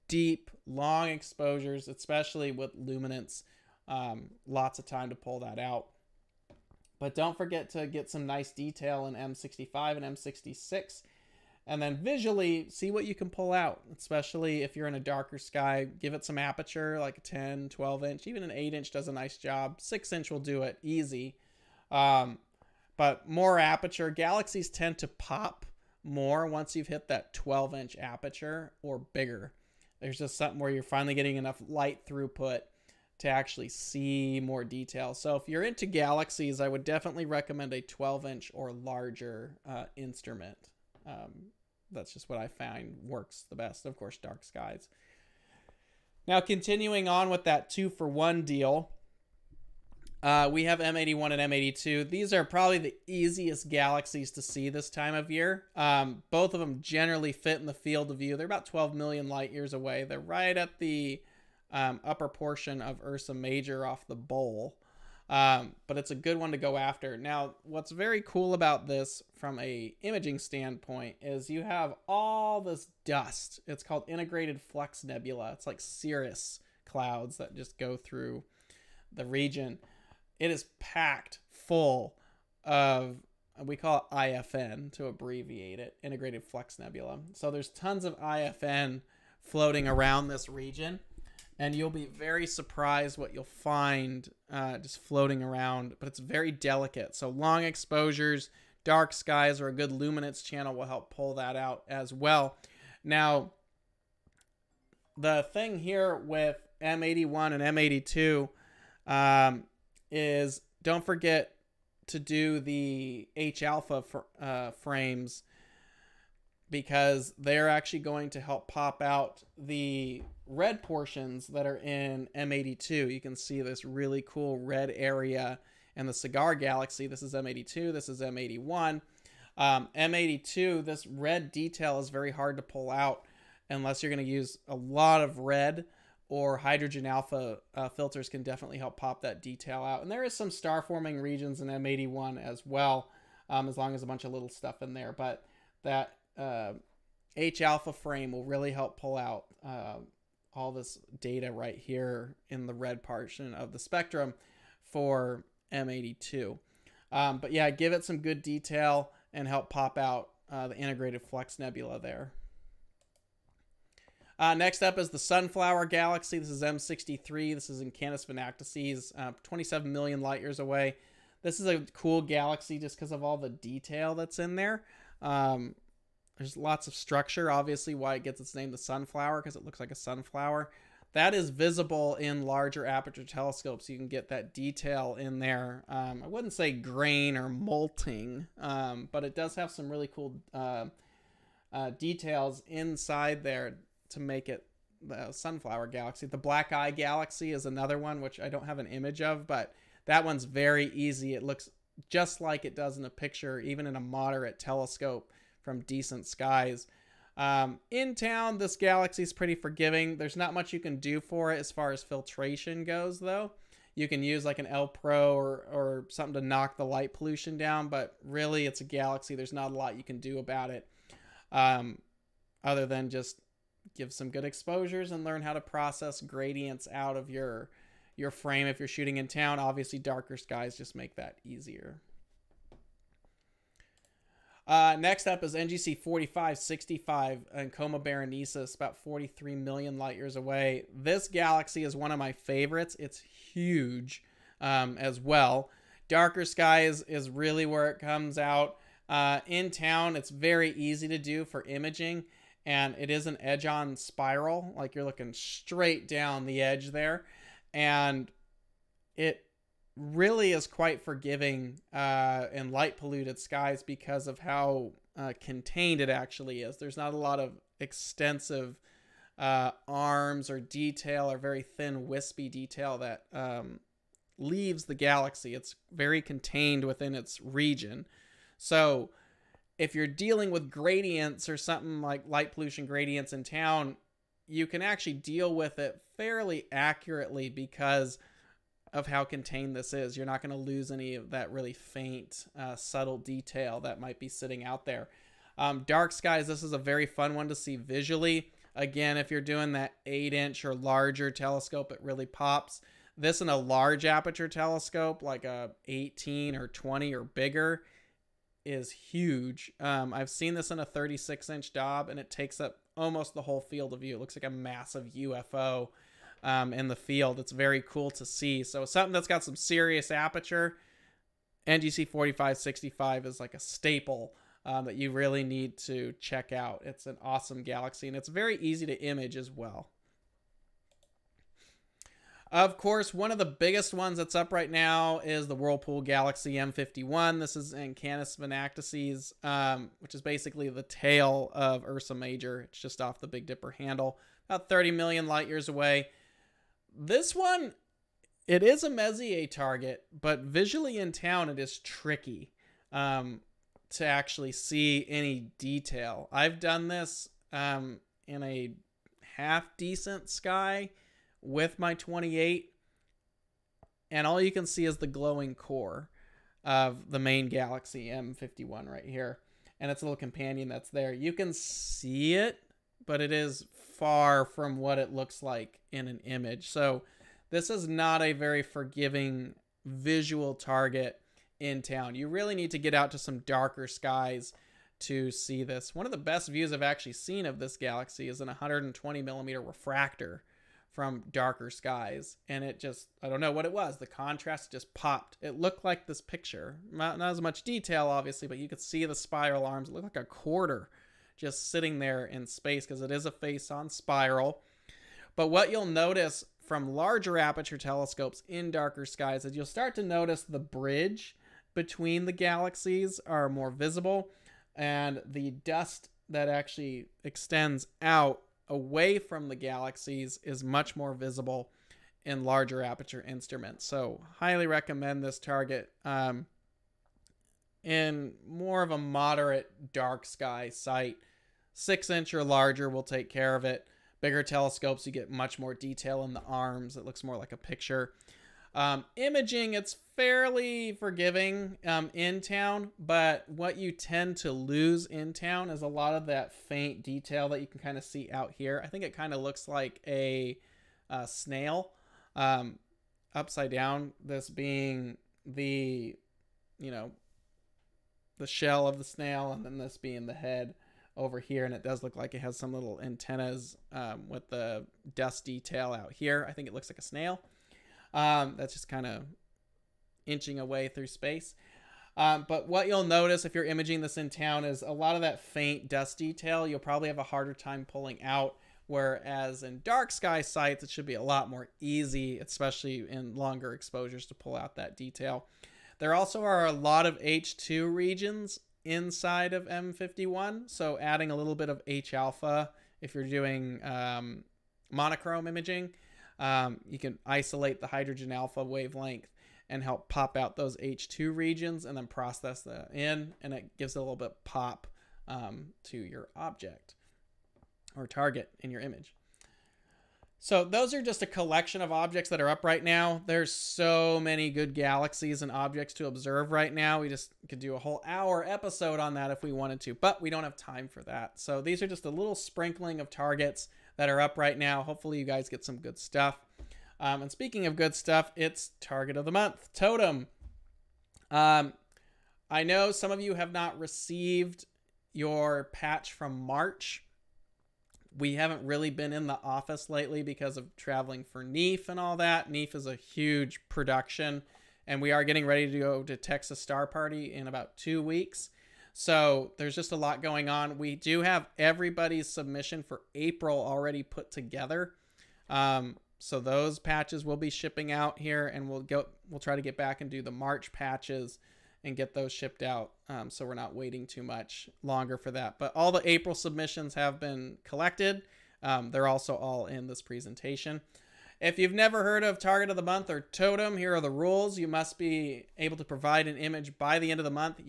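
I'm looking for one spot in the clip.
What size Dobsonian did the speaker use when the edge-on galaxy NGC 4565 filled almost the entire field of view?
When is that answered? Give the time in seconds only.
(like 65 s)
310 s.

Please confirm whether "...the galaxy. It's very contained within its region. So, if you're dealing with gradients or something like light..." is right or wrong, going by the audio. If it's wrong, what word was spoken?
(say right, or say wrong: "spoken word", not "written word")
right.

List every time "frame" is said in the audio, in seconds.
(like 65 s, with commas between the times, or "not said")
114 s, 147 s, 228 s.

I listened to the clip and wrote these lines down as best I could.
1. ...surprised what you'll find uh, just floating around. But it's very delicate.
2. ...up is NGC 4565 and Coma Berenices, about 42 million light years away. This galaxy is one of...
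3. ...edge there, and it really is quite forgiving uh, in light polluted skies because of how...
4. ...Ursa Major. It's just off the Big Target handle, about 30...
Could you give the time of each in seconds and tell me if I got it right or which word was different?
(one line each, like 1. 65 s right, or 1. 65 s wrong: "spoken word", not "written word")
1. 92 s right
2. 235 s wrong: "43", not "42"
3. 256 s right
4. 341 s wrong: "Dipper", not "Target".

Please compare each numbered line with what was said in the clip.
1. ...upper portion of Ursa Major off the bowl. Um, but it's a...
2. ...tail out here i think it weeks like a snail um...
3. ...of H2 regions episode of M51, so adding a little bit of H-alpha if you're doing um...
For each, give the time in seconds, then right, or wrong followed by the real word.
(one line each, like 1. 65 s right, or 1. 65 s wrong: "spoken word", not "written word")
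1. 62 s right
2. 465 s wrong: "looks", not "weeks"
3. 487 s wrong: "inside", not "episode".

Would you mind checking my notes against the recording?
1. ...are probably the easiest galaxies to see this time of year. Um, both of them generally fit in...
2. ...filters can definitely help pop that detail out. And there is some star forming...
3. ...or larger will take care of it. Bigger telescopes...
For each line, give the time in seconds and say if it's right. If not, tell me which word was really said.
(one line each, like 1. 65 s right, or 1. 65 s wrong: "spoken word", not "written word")
1. 52 s right
2. 137 s right
3. 432 s right.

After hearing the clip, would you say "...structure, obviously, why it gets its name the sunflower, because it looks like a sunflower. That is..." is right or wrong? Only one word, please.
right.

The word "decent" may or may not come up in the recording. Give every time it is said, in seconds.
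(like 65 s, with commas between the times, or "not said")
205 s, 359 s.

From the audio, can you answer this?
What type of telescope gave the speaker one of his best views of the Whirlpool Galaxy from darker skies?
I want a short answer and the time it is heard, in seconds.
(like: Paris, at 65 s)
120 millimeter refractor, at 388 s.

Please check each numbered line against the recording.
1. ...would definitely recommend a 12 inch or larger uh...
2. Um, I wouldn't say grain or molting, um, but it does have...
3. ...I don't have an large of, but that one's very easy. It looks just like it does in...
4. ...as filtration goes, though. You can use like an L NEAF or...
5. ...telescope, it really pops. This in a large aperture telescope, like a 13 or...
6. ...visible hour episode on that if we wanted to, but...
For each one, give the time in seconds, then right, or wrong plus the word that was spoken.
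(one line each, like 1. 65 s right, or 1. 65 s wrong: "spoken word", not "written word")
1. 36 s right
2. 185 s right
3. 198 s wrong: "image", not "large"
4. 211 s wrong: "Pro", not "NEAF"
5. 301 s wrong: "18", not "13"
6. 517 s wrong: "whole", not "visible".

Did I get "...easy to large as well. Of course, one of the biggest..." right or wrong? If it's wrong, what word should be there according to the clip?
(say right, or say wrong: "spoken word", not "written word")
wrong: "image", not "large".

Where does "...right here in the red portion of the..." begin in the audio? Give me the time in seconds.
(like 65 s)
151 s.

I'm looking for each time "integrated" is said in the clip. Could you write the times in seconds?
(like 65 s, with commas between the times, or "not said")
74 s, 86 s, 160 s.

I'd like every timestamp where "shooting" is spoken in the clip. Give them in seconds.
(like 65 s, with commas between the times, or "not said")
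228 s.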